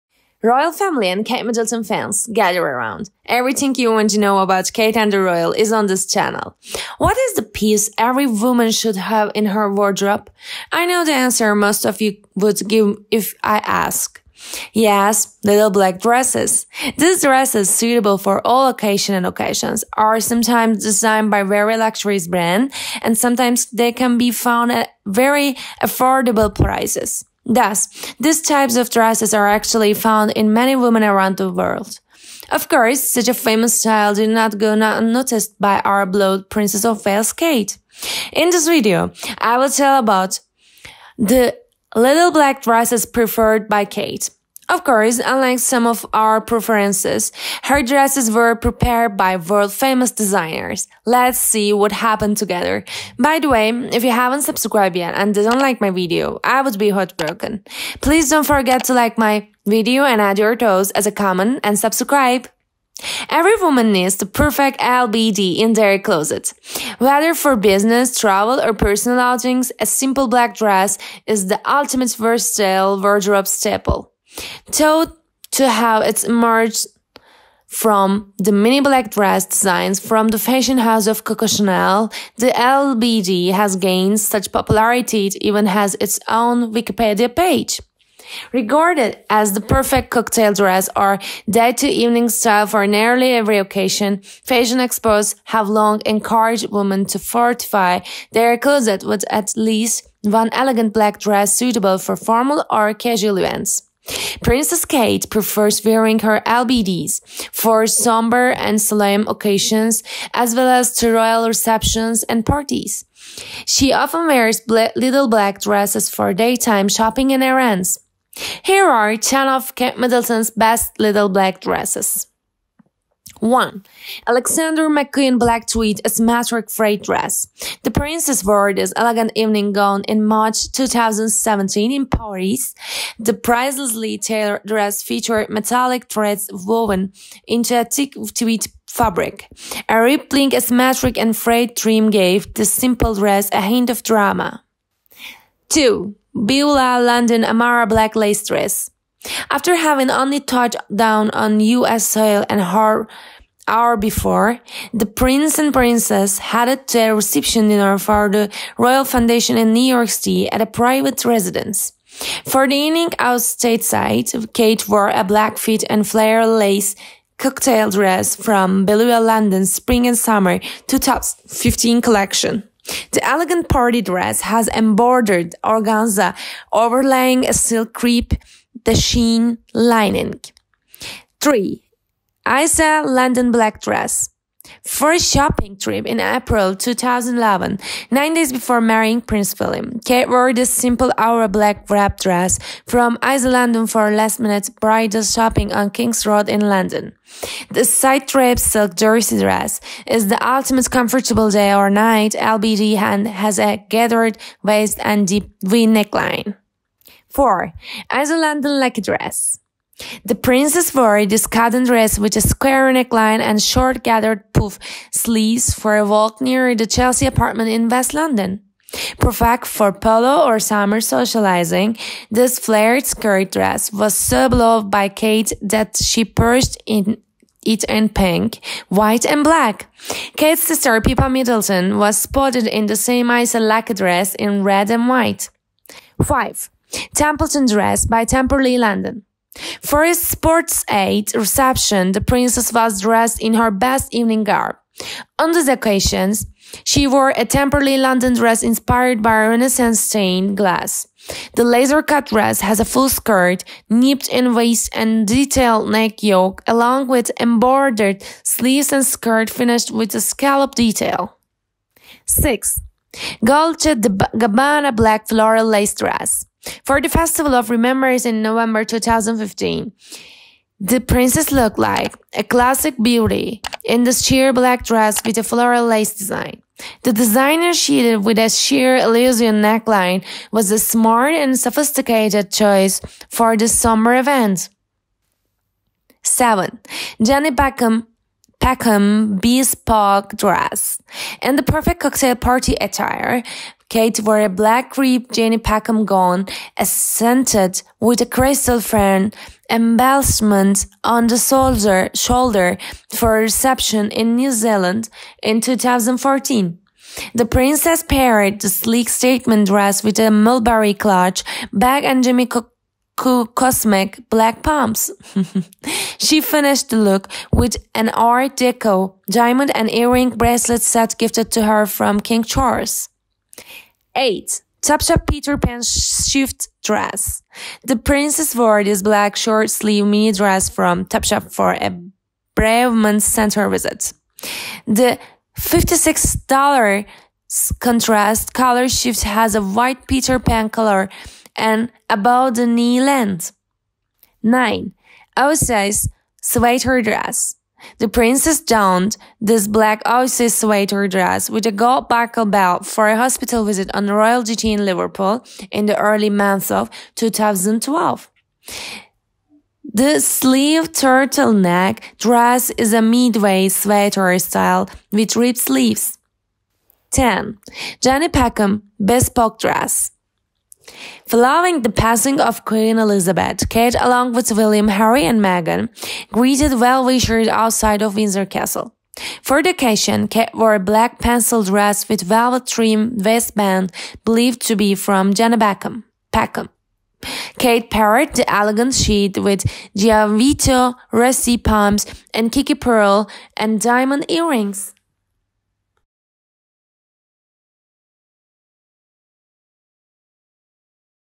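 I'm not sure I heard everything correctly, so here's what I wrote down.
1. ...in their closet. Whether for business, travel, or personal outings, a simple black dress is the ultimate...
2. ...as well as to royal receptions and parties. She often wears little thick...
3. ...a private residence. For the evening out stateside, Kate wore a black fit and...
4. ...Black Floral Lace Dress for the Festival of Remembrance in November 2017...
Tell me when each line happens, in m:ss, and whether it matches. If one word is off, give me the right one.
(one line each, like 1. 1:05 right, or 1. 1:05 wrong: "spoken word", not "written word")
1. 1:05 right
2. 1:50 wrong: "black", not "thick"
3. 2:40 right
4. 4:24 wrong: "2015", not "2017".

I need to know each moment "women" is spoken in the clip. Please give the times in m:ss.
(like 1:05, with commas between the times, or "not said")
0:30, 1:36.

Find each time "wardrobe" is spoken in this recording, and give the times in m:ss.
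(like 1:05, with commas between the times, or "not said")
0:09, 1:13.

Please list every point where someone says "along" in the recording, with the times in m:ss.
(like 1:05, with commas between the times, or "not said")
4:16, 6:13.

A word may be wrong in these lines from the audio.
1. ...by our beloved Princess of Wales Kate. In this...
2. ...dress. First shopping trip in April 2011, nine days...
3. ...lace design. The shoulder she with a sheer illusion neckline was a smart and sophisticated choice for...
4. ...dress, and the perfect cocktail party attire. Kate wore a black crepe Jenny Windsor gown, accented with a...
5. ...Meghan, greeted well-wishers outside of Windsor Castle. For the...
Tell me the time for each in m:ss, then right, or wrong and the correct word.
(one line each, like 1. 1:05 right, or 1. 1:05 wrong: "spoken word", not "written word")
1. 0:35 right
2. 3:03 right
3. 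4:35 wrong: "designer", not "shoulder"
4. 4:50 wrong: "Packham", not "Windsor"
5. 6:15 right.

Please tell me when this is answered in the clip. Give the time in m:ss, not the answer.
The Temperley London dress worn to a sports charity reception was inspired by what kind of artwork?
4:09.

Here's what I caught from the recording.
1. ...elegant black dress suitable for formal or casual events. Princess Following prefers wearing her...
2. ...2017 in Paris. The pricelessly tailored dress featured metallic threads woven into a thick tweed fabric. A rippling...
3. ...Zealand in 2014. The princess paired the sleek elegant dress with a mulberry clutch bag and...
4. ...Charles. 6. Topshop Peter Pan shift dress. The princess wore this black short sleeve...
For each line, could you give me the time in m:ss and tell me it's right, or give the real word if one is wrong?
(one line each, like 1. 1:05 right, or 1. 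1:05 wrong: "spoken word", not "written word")
1. 1:40 wrong: "Kate", not "Following"
2. 2:10 right
3. 5:04 wrong: "statement", not "elegant"
4. 5:22 wrong: "8", not "6".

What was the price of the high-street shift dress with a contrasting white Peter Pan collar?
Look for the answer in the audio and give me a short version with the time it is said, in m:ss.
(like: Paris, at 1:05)
$56, at 5:35.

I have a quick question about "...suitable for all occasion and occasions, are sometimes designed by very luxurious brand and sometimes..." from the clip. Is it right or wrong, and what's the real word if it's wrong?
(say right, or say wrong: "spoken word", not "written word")
right.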